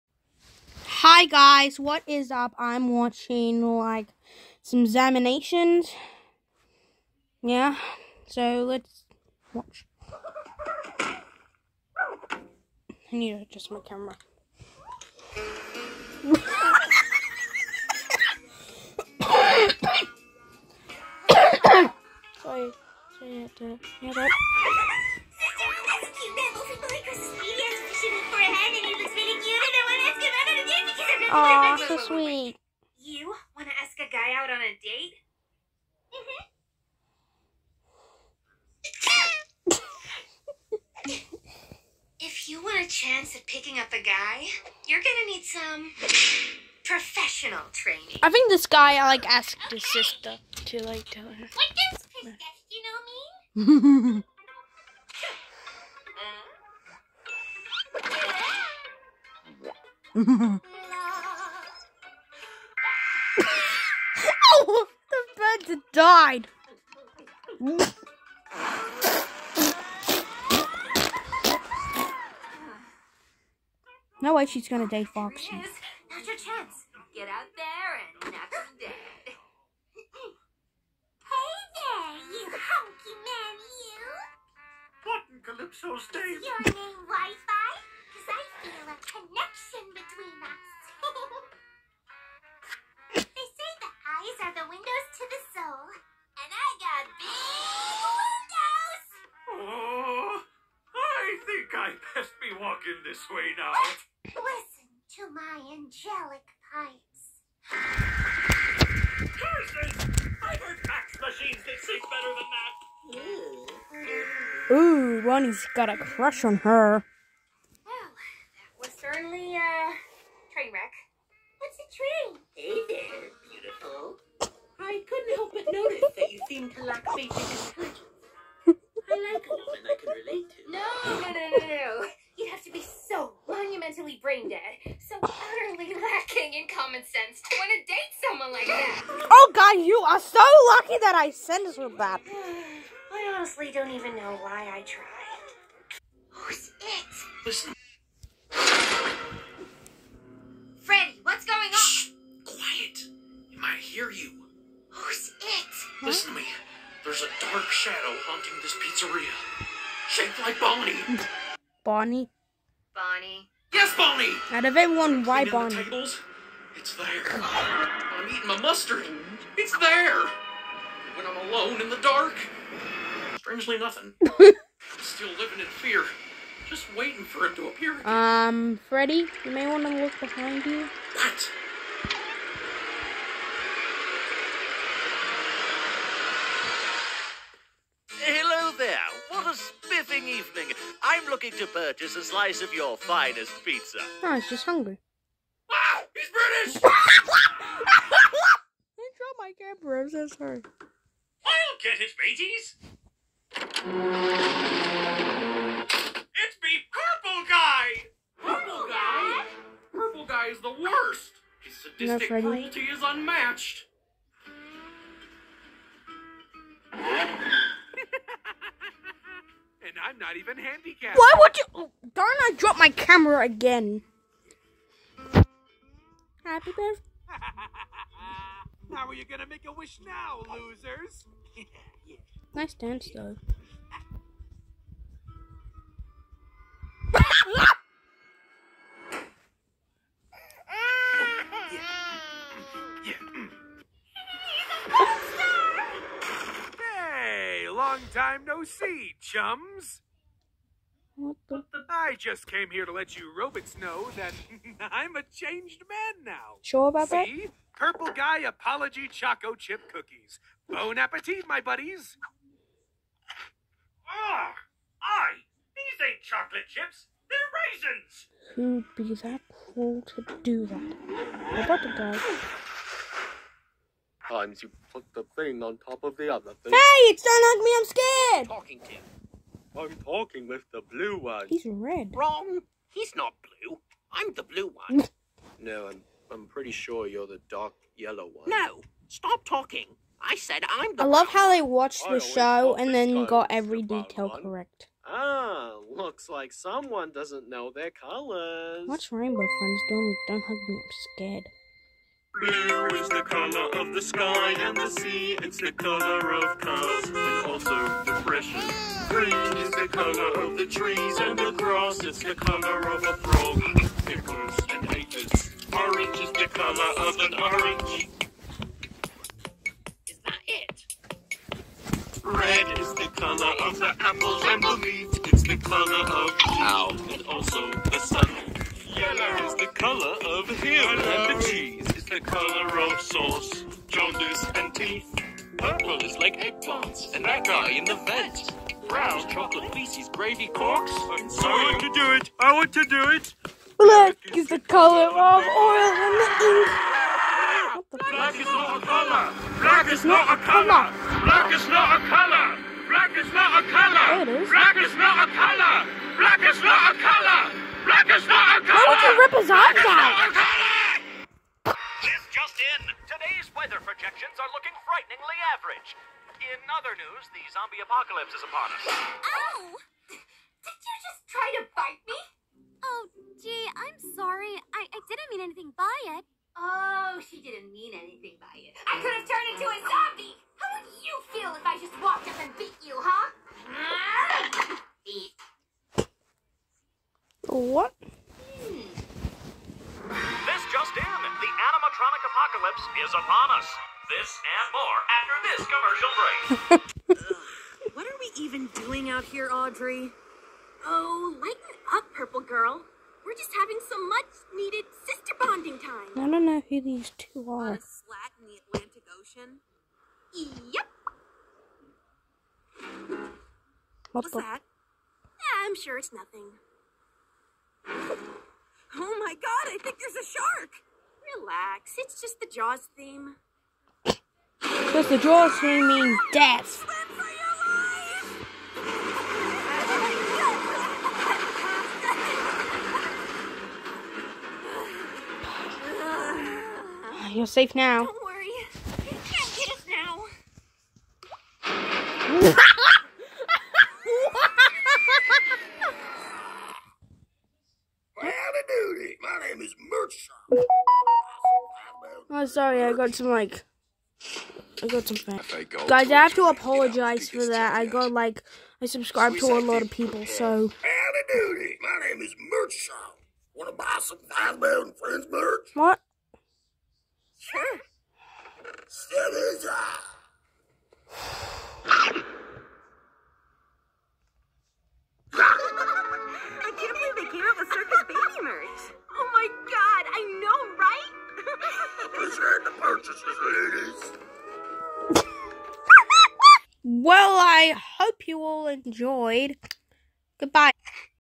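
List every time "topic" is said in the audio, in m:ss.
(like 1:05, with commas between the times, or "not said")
not said.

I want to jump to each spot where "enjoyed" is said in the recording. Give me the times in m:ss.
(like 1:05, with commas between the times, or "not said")
8:08.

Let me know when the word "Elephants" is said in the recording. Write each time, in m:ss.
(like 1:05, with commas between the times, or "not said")
not said.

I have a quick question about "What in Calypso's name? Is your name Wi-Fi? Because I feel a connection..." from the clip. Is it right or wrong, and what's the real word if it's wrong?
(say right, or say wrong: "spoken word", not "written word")
right.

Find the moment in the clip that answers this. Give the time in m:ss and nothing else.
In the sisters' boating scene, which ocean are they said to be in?
6:48.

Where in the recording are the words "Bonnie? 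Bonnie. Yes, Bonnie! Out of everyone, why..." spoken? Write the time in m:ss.
2:41.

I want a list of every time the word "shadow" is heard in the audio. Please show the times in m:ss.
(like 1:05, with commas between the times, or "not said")
2:37.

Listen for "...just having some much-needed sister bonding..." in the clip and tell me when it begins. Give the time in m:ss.
6:43.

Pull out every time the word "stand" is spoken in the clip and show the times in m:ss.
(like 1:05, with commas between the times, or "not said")
not said.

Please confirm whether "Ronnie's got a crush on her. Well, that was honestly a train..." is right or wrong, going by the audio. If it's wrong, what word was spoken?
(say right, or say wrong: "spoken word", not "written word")
wrong: "certainly", not "honestly".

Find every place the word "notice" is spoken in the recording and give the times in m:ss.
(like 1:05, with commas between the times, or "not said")
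2:05.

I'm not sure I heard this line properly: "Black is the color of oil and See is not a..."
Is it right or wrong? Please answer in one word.
wrong.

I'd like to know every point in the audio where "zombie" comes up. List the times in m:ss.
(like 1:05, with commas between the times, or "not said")
6:07, 6:19.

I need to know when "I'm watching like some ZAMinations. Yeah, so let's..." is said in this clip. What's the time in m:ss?
0:02.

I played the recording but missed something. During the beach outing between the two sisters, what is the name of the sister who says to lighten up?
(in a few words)
Audrey.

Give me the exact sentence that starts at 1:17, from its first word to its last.
Get out there and knock him dead.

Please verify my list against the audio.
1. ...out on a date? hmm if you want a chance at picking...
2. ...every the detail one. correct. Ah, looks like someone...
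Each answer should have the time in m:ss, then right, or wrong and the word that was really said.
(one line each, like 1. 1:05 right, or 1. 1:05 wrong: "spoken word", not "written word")
1. 0:34 right
2. 4:53 right.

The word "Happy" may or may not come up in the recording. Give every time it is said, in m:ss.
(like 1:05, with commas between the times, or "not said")
3:46.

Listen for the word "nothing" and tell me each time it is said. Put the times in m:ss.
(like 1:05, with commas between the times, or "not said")
2:53, 6:56.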